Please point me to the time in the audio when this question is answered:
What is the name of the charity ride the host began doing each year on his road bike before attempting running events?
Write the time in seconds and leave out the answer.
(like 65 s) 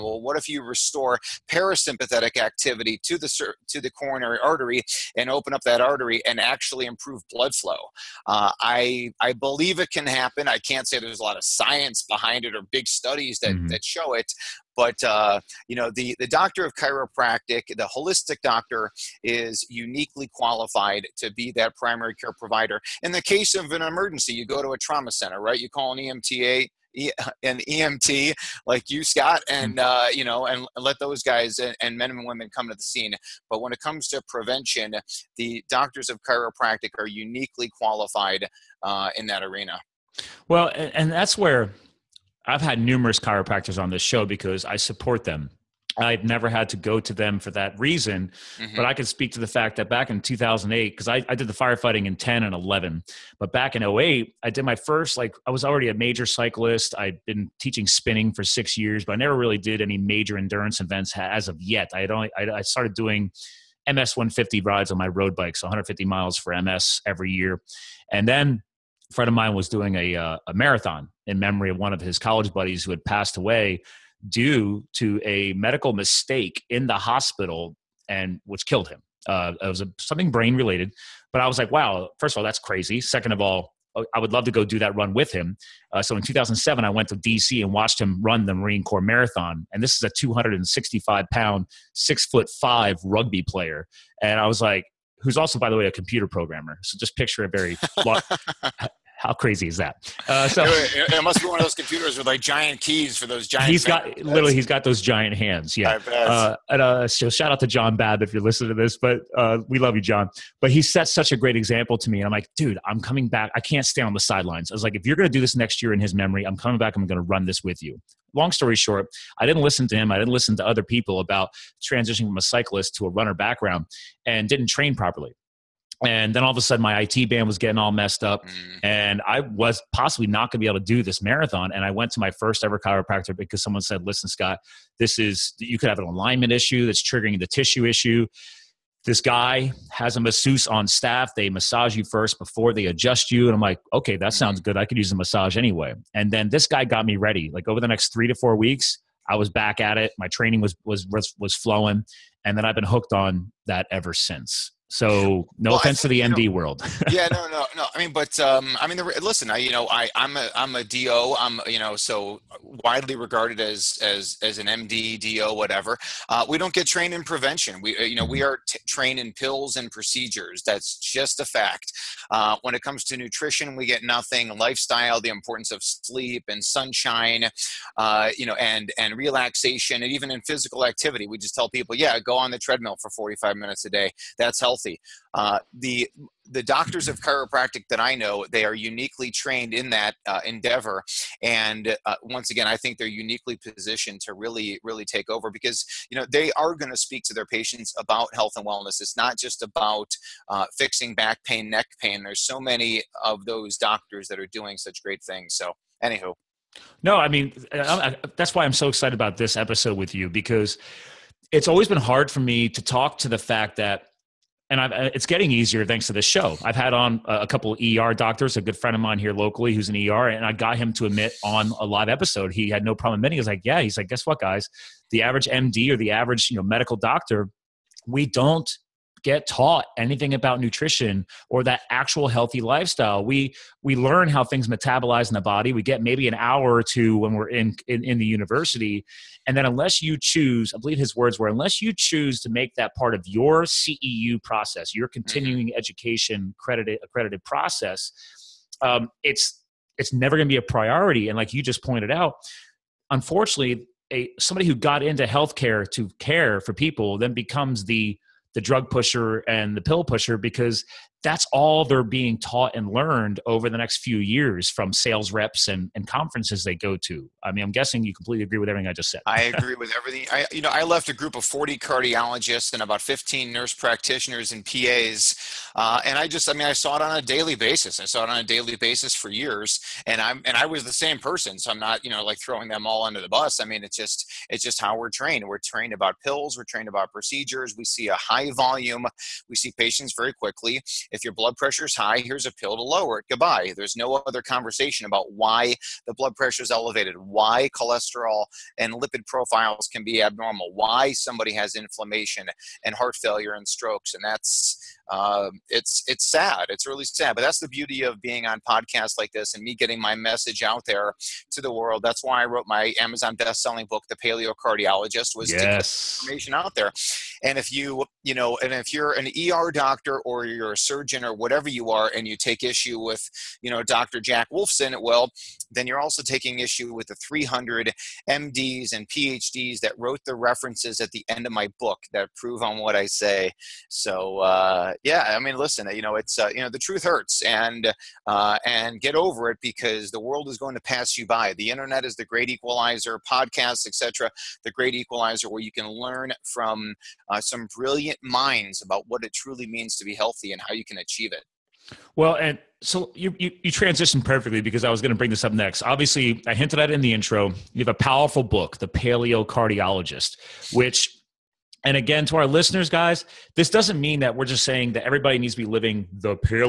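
63 s.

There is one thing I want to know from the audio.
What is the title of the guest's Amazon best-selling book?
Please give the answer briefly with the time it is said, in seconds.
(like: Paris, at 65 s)
The Paleocardiologist, at 314 s.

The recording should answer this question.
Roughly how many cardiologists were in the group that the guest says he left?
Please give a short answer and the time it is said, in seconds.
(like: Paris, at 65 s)
40, at 271 s.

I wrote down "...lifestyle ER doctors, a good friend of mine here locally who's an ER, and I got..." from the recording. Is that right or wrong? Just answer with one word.
wrong.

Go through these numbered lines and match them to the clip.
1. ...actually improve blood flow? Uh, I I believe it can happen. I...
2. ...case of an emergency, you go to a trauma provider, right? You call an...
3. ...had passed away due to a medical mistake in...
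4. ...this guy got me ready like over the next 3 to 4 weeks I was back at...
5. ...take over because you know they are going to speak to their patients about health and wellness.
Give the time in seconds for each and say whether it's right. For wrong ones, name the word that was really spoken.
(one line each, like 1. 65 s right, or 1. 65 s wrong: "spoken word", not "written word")
1. 6 s right
2. 23 s wrong: "center", not "provider"
3. 72 s right
4. 146 s right
5. 195 s right.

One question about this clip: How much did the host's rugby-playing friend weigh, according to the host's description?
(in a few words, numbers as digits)
265 pounds.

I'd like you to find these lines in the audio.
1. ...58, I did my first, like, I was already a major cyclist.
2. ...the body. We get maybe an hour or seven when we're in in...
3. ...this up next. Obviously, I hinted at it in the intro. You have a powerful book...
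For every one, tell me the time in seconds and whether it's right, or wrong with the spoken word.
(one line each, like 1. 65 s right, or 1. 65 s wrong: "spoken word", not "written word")
1. 53 s wrong: "08", not "58"
2. 235 s wrong: "two", not "seven"
3. 355 s right.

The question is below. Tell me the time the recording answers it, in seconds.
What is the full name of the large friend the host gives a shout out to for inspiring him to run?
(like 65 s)
107 s.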